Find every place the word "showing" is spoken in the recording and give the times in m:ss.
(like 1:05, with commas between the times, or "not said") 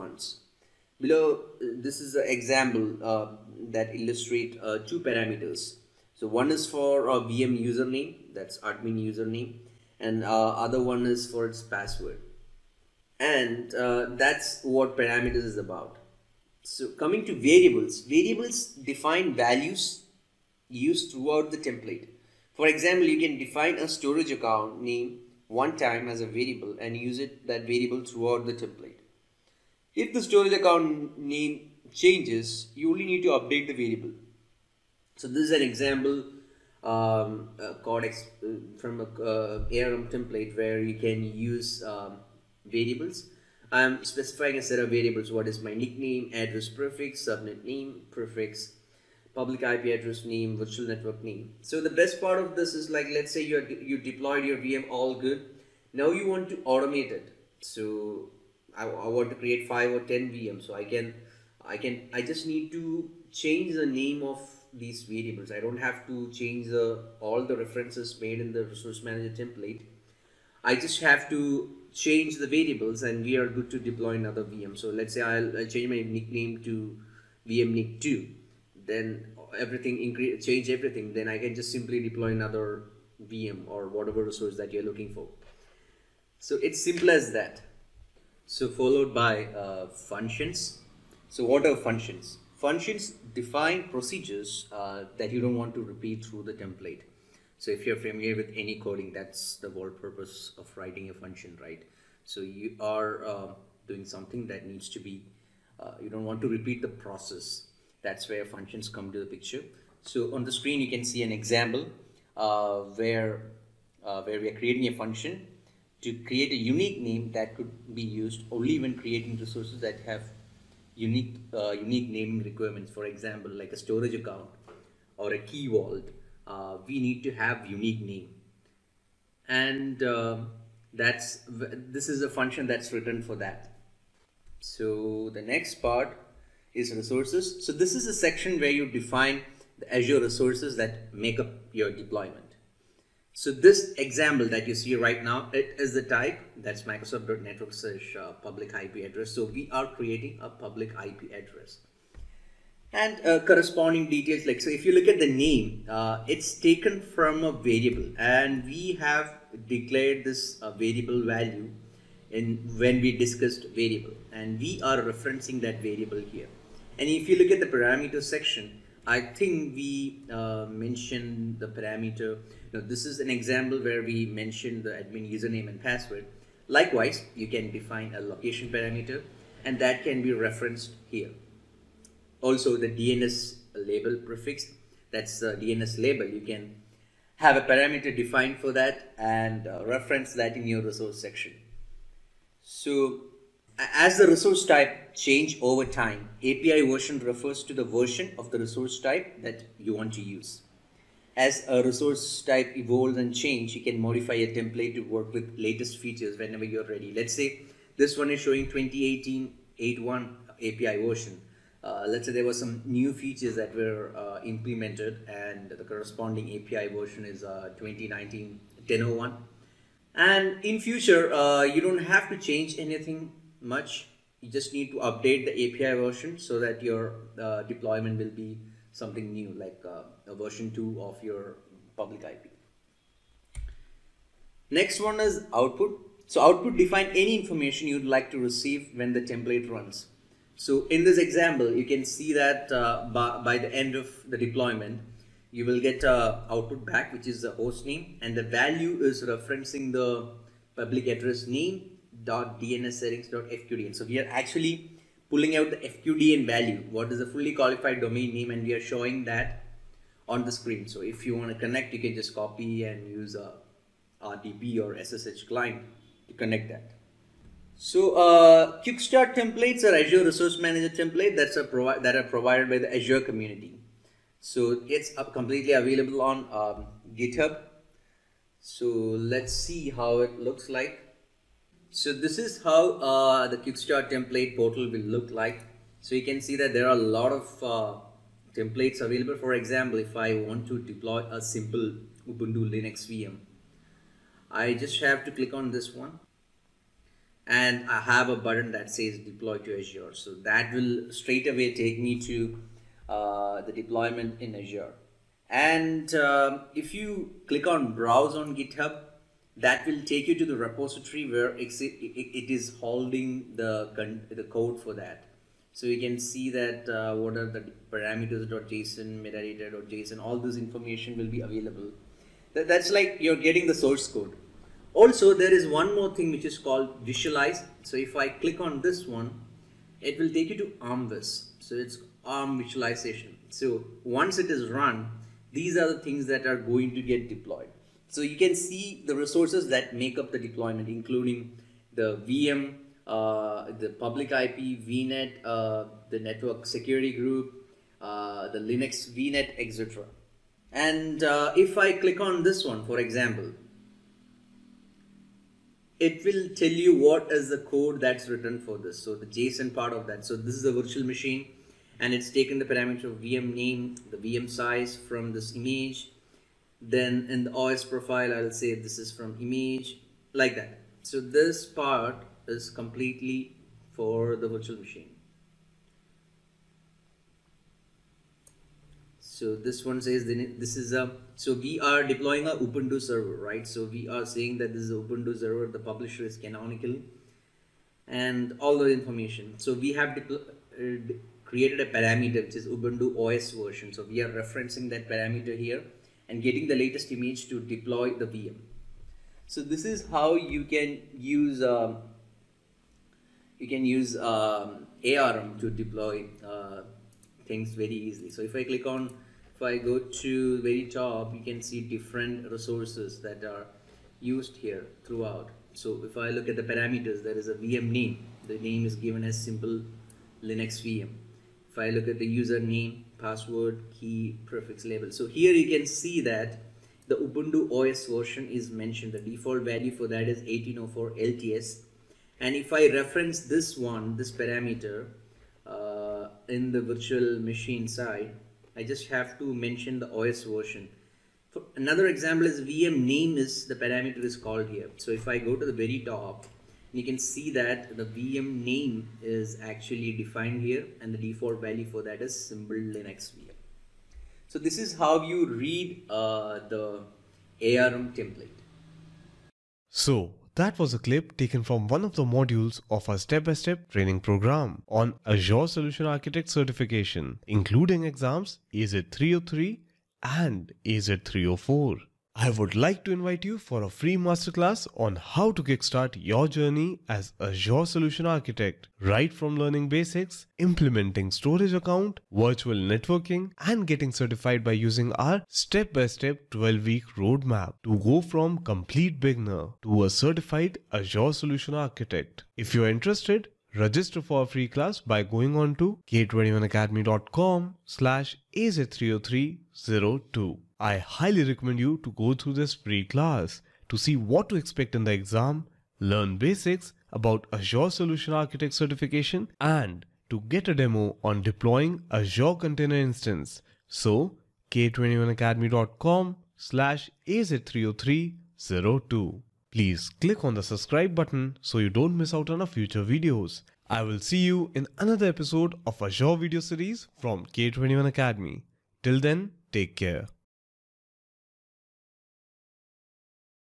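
3:28, 4:18.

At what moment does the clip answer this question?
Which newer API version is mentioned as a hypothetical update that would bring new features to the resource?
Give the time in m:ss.
3:37.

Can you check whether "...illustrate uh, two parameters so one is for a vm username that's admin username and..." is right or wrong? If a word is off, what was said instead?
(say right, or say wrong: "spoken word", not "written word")
right.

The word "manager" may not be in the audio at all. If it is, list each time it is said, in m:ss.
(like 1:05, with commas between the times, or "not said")
1:09, 4:30.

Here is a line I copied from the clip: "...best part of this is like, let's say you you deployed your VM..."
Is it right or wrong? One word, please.
right.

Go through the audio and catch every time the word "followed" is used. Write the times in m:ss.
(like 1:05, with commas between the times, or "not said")
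1:28.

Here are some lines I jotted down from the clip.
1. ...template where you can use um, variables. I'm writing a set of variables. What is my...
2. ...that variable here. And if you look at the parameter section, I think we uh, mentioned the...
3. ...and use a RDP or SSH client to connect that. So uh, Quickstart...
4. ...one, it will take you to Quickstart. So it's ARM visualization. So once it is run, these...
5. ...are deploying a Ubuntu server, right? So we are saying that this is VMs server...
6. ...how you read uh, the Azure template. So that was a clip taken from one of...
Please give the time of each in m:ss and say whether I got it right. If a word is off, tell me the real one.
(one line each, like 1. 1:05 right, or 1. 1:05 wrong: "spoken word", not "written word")
1. 0:40 wrong: "specifying", not "writing"
2. 2:45 right
3. 4:22 right
4. 5:29 wrong: "ArmViz", not "Quickstart"
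5. 6:21 wrong: "Ubuntu", not "VMs"
6. 7:34 wrong: "ARM", not "Azure".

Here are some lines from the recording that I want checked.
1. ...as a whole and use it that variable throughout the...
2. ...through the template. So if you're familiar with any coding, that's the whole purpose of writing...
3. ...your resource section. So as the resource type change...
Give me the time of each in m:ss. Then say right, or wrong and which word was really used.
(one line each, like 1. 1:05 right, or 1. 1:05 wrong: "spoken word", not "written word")
1. 0:26 wrong: "variable", not "whole"
2. 1:36 right
3. 3:10 right.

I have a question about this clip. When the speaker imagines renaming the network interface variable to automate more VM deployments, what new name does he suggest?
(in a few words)
Nick 2.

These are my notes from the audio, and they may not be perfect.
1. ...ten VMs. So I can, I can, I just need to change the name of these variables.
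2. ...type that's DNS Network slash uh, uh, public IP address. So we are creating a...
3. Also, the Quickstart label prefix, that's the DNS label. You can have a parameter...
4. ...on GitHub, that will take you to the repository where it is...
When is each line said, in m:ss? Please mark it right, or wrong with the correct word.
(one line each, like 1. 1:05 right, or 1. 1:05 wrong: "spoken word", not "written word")
1. 1:00 right
2. 2:26 wrong: "Microsoft", not "DNS"
3. 3:02 wrong: "DNS", not "Quickstart"
4. 5:08 right.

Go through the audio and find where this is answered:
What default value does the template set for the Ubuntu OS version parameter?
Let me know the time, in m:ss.
7:10.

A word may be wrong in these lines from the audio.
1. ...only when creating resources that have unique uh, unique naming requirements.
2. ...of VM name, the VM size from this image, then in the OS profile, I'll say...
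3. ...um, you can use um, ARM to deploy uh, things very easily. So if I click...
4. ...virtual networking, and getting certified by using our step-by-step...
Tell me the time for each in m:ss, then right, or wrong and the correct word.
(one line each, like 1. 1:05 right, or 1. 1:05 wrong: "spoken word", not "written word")
1. 1:58 right
2. 6:03 right
3. 6:41 right
4. 8:02 right.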